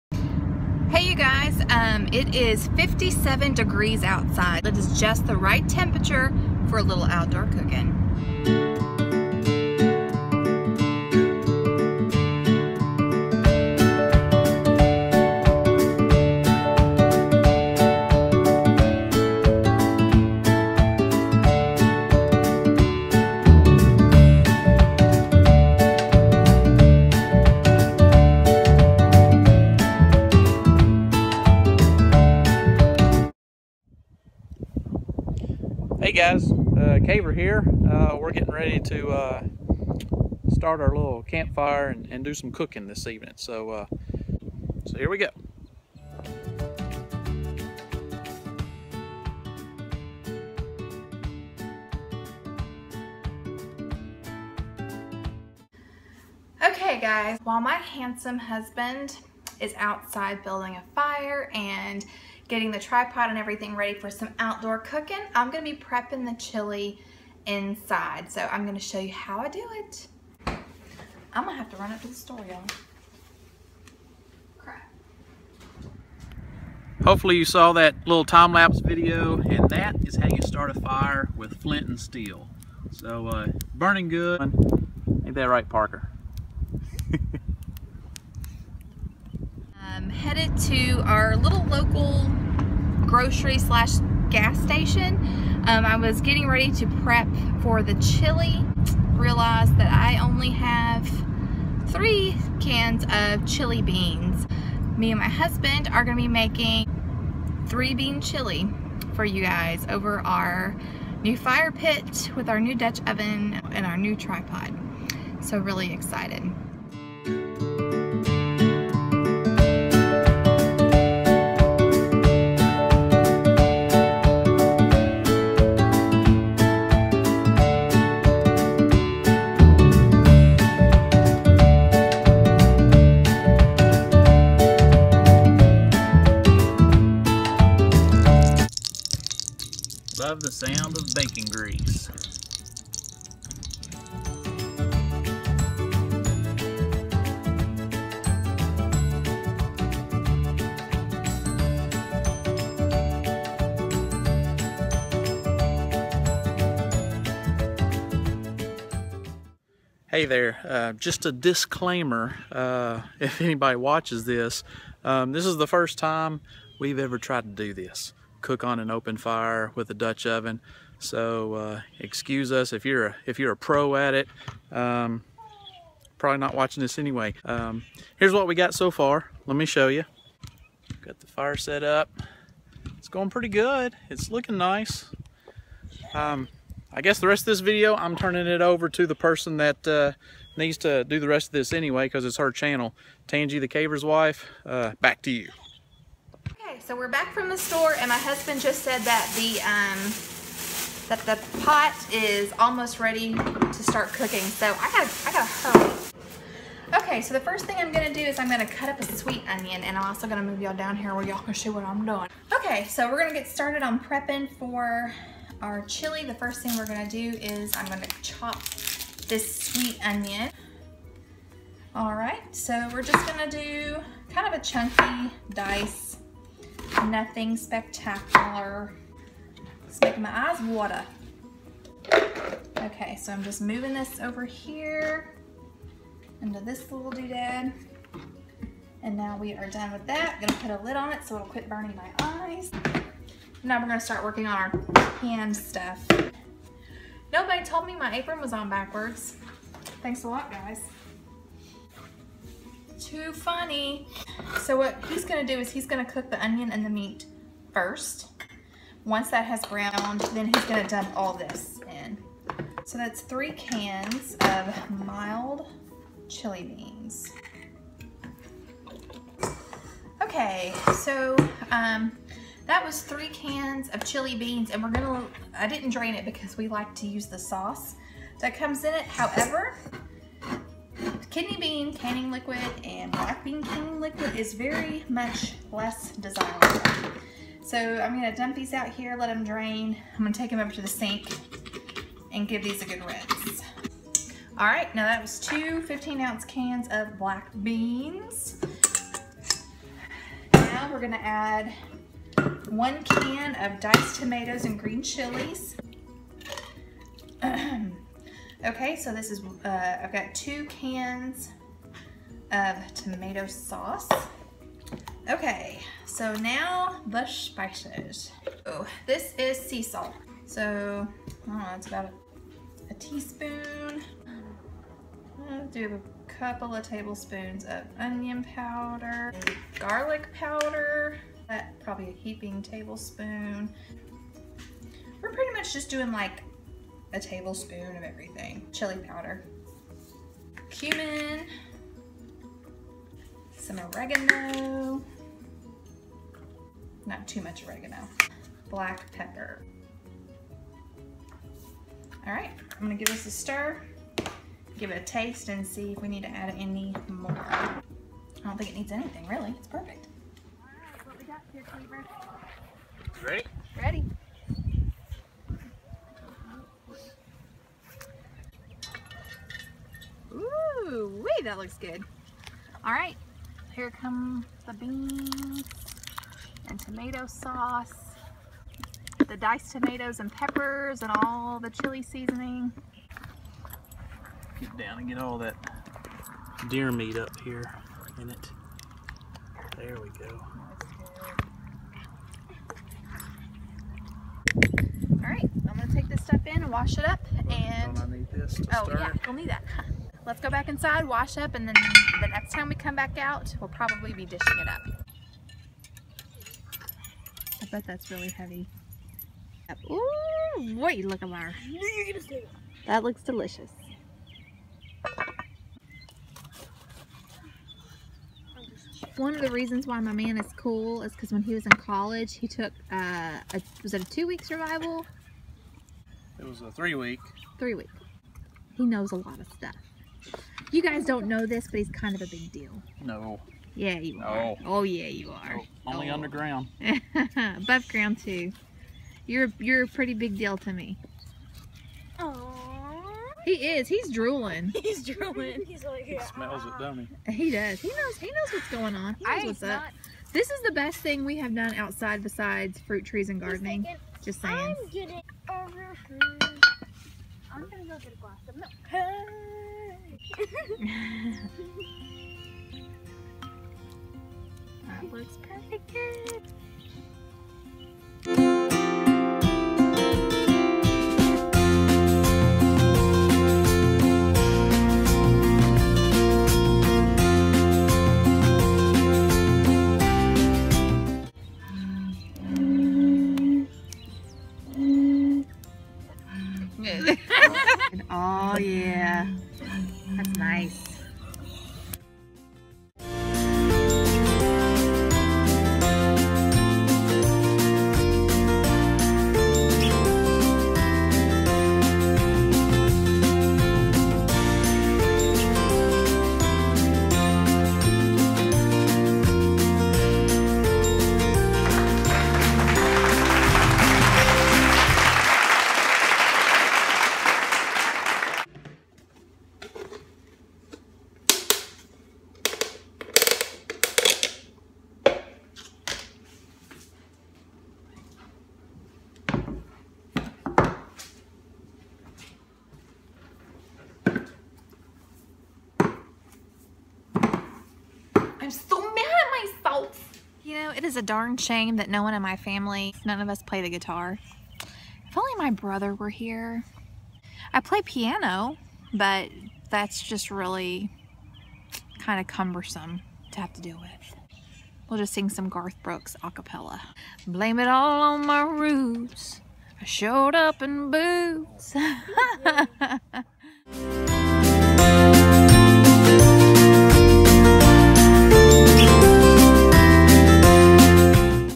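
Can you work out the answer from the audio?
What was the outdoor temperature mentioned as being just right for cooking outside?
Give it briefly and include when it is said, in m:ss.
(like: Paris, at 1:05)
57 degrees, at 0:02.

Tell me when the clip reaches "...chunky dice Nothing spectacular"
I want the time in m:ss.
3:44.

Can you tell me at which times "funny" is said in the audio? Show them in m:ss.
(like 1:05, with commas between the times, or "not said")
4:13.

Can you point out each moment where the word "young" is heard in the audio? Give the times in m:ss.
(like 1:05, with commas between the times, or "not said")
not said.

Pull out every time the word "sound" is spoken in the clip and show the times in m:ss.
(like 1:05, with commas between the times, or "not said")
2:20.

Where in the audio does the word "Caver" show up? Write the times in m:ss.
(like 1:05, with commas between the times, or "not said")
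0:37, 3:13.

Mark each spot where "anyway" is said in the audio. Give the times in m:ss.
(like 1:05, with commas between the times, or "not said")
2:56, 3:11.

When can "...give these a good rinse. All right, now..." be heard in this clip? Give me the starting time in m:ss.
4:52.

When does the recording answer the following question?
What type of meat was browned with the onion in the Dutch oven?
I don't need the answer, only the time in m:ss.
6:26.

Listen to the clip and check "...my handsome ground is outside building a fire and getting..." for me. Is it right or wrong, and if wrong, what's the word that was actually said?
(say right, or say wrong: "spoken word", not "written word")
wrong: "husband", not "ground".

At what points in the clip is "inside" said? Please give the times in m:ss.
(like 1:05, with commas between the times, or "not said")
1:07, 6:40.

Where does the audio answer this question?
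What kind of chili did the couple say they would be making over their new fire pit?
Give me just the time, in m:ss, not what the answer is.
1:47.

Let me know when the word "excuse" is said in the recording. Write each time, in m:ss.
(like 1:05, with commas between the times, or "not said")
2:51.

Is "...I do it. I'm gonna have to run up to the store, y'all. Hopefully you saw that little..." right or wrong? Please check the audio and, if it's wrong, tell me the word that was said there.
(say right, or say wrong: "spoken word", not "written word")
right.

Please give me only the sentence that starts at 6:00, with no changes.
All right, what we got here, Cleaver?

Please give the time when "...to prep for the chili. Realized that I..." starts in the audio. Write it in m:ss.
1:36.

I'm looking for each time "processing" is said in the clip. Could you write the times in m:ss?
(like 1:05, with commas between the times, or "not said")
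not said.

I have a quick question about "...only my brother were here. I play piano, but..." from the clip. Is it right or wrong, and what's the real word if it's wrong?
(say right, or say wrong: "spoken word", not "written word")
right.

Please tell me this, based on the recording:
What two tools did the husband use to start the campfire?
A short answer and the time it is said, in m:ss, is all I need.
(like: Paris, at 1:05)
flint and steel, at 1:21.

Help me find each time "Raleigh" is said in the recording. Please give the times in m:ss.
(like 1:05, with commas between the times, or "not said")
not said.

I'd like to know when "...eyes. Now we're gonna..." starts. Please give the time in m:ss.
4:02.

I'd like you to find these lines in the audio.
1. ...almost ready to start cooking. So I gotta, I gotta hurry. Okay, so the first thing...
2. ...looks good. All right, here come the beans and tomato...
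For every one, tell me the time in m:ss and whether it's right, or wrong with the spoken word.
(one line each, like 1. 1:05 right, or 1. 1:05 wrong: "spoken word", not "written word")
1. 3:22 right
2. 6:11 right.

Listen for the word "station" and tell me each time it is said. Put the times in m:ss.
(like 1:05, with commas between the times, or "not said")
1:34.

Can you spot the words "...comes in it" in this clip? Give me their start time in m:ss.
4:38.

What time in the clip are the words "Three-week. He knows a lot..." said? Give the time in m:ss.
7:07.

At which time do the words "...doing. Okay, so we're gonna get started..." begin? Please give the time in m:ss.
3:32.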